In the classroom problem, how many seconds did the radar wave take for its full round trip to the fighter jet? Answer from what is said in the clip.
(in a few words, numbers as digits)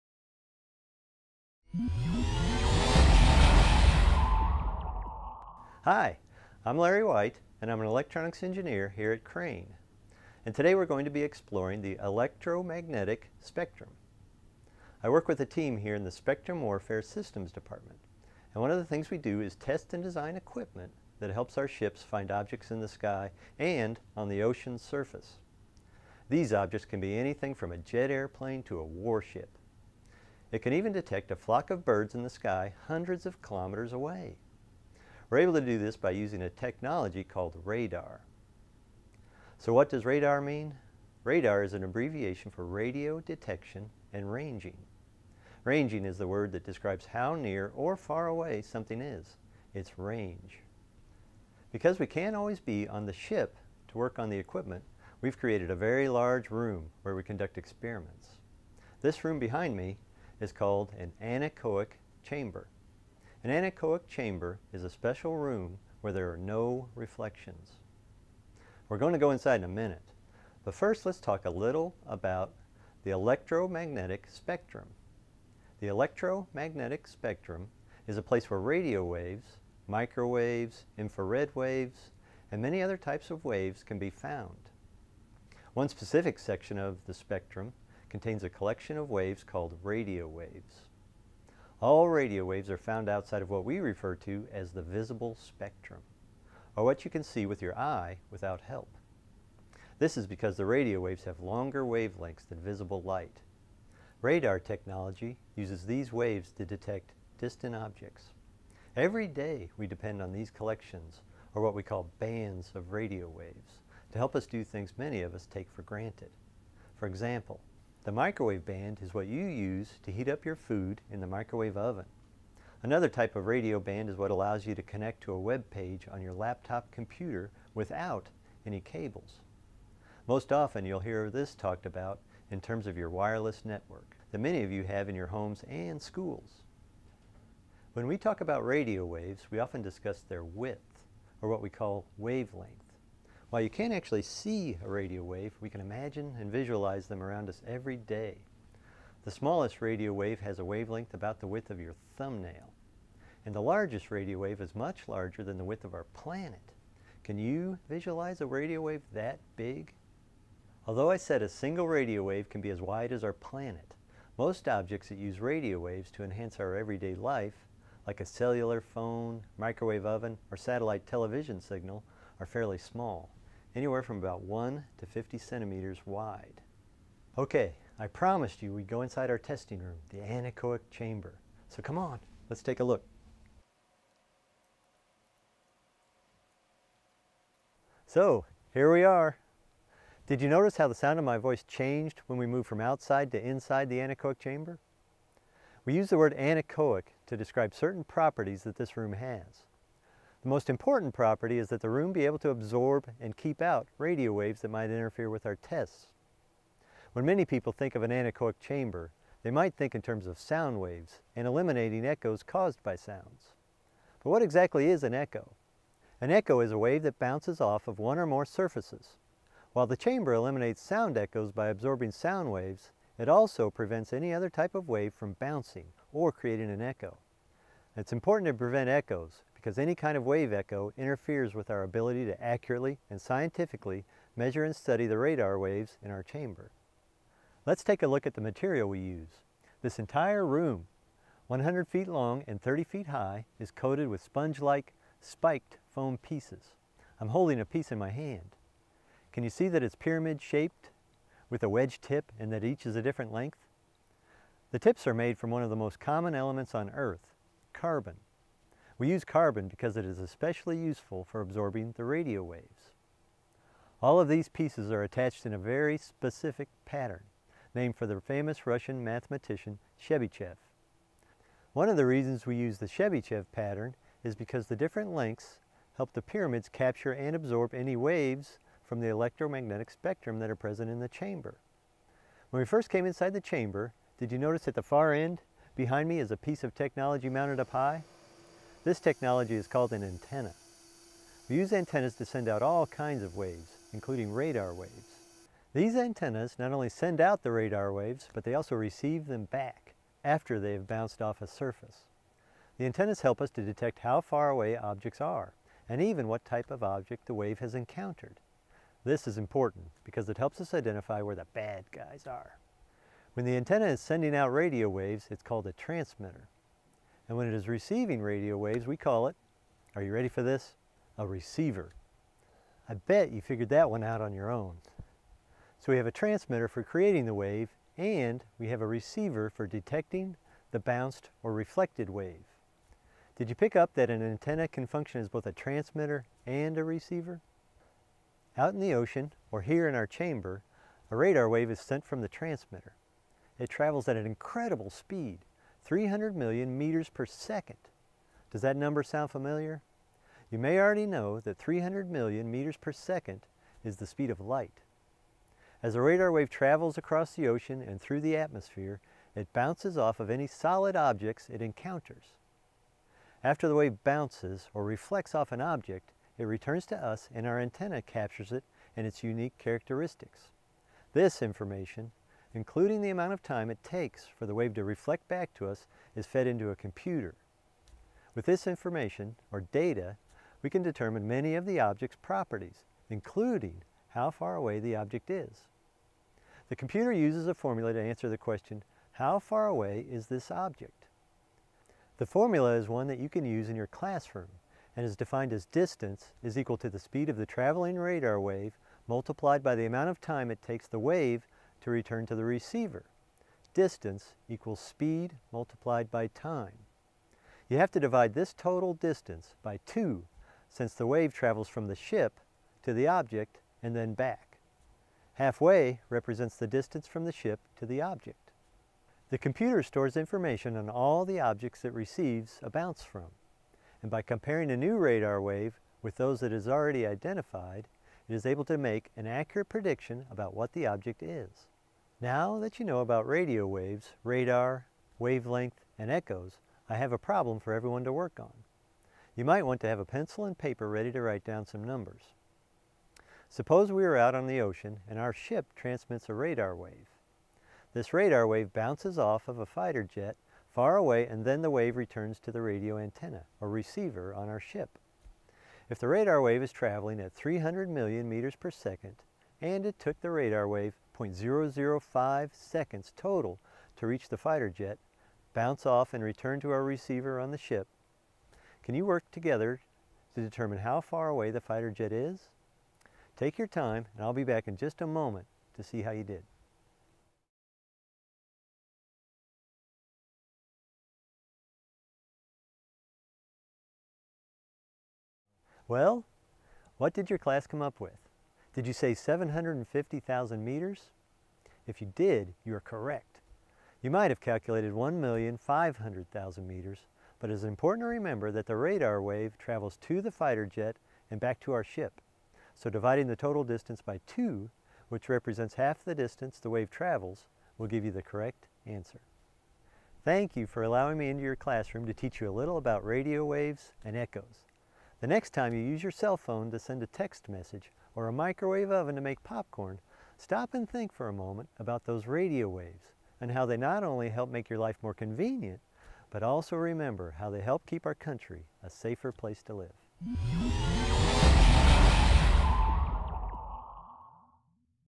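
0.005 seconds.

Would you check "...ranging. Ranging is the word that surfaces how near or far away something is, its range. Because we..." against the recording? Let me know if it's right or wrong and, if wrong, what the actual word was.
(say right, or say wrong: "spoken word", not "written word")
wrong: "describes", not "surfaces".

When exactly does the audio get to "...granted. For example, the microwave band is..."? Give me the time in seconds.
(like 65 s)
115 s.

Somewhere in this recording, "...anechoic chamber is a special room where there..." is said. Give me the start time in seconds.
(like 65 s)
63 s.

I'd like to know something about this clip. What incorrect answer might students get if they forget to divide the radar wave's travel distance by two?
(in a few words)
1,500,000 meters.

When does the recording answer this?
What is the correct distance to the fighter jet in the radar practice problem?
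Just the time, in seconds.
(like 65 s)
489 s.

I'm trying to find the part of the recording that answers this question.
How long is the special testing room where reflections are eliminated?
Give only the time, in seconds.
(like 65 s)
241 s.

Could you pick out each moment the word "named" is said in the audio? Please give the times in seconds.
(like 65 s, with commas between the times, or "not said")
267 s.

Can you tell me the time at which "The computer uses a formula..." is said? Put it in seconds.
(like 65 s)
386 s.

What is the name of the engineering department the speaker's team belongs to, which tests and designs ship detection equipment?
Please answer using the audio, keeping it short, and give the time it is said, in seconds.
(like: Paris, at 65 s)
Spectrum Warfare Systems Department, at 16 s.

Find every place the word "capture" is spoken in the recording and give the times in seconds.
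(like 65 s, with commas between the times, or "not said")
276 s, 368 s.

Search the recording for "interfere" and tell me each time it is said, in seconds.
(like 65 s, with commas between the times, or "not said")
204 s, 230 s.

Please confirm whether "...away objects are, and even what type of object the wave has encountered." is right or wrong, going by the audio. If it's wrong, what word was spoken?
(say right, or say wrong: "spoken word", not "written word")
right.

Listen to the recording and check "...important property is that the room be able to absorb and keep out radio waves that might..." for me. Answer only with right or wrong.
right.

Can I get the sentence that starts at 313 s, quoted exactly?
When the antenna is sending out radio waves, it's called a transmitter.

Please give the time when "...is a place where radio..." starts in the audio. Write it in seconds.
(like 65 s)
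78 s.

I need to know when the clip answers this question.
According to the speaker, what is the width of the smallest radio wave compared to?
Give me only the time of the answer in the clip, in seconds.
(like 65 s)
151 s.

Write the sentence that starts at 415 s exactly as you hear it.
Halfway represents the distance from the ship to the object.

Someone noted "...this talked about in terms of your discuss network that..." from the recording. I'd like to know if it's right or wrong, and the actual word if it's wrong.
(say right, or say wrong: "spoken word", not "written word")
wrong: "wireless", not "discuss".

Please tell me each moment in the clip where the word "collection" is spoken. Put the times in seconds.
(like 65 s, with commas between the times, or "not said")
88 s, 110 s.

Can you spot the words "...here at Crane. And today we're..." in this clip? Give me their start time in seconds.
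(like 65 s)
8 s.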